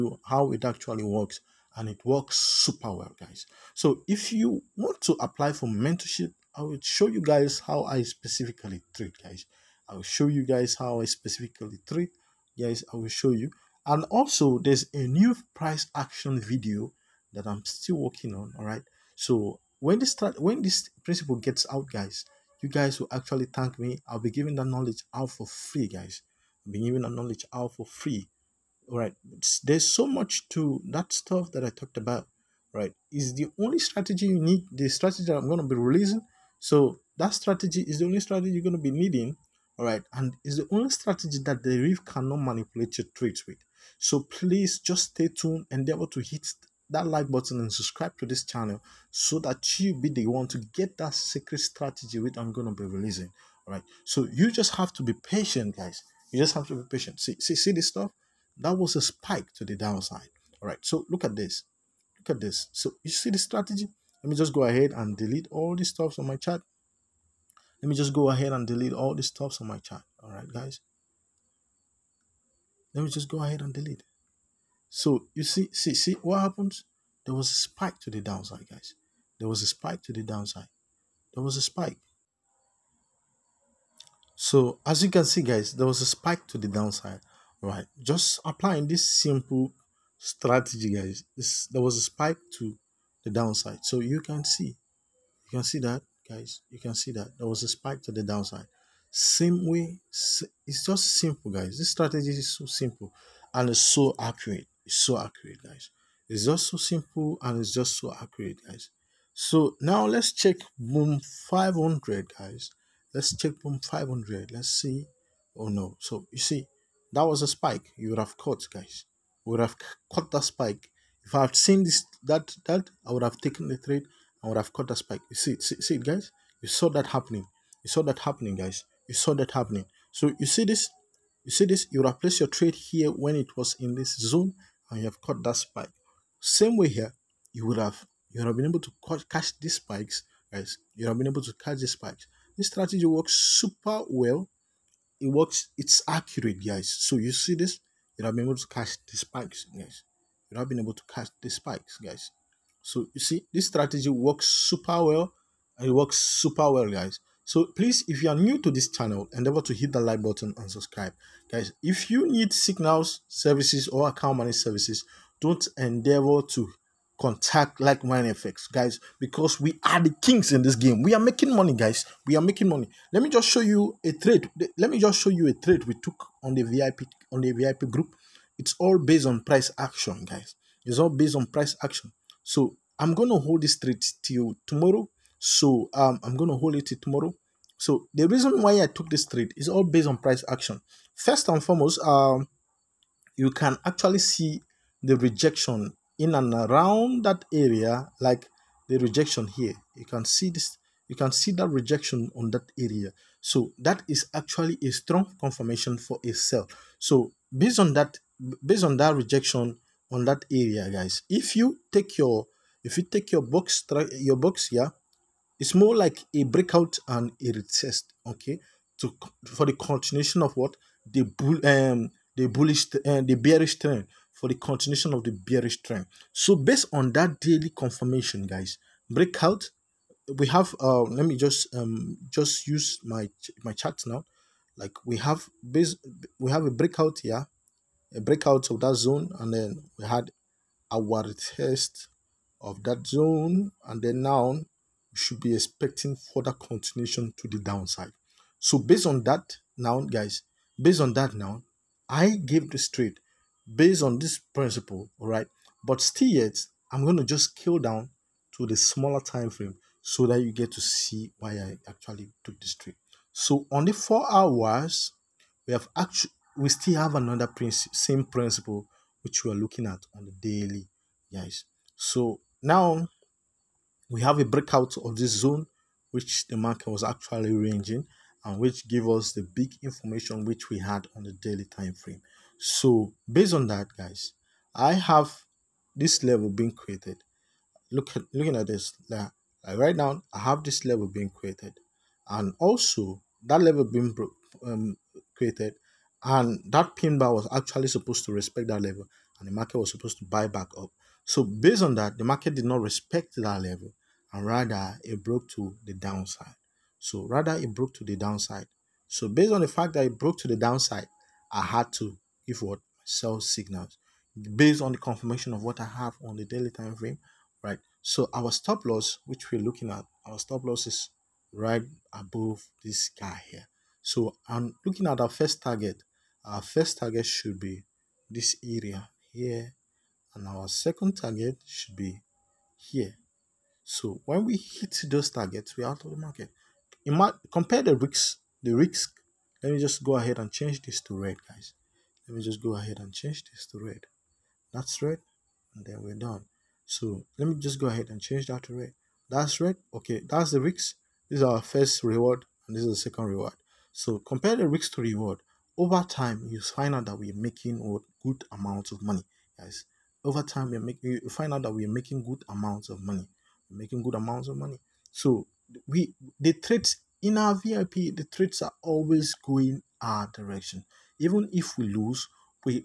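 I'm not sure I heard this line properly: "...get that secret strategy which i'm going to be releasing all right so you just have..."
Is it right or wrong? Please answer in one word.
right.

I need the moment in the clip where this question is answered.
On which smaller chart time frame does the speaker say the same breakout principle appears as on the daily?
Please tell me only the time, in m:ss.
4:23.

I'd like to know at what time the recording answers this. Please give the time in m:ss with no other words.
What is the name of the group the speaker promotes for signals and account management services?
2:47.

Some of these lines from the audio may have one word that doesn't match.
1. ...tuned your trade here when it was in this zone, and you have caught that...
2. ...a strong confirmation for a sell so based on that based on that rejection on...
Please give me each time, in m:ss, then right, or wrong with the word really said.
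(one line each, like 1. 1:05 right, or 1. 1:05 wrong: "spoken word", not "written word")
1. 2:12 wrong: "placed", not "tuned"
2. 3:24 right.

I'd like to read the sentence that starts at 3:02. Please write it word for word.
So I'm gonna hold this trade till tomorrow.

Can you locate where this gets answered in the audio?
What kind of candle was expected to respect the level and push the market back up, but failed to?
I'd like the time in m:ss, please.
4:56.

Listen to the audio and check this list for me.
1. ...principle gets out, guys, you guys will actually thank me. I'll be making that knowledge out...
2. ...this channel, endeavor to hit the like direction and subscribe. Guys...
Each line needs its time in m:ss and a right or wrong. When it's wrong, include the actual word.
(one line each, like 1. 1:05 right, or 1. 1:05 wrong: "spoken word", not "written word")
1. 0:21 wrong: "giving", not "making"
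2. 2:38 wrong: "button", not "direction".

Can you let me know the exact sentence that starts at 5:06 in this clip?
So rather it broke to the downside.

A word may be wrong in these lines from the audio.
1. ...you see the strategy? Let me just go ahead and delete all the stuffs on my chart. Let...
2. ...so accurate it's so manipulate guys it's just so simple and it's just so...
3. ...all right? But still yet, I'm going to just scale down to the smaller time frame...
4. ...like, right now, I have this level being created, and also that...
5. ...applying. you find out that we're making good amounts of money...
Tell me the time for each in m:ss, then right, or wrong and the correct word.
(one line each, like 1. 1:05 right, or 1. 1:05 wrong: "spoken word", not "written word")
1. 1:03 right
2. 1:43 wrong: "accurate", not "manipulate"
3. 4:15 right
4. 4:49 right
5. 6:00 wrong: "making", not "applying".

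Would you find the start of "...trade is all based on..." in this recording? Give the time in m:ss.
3:09.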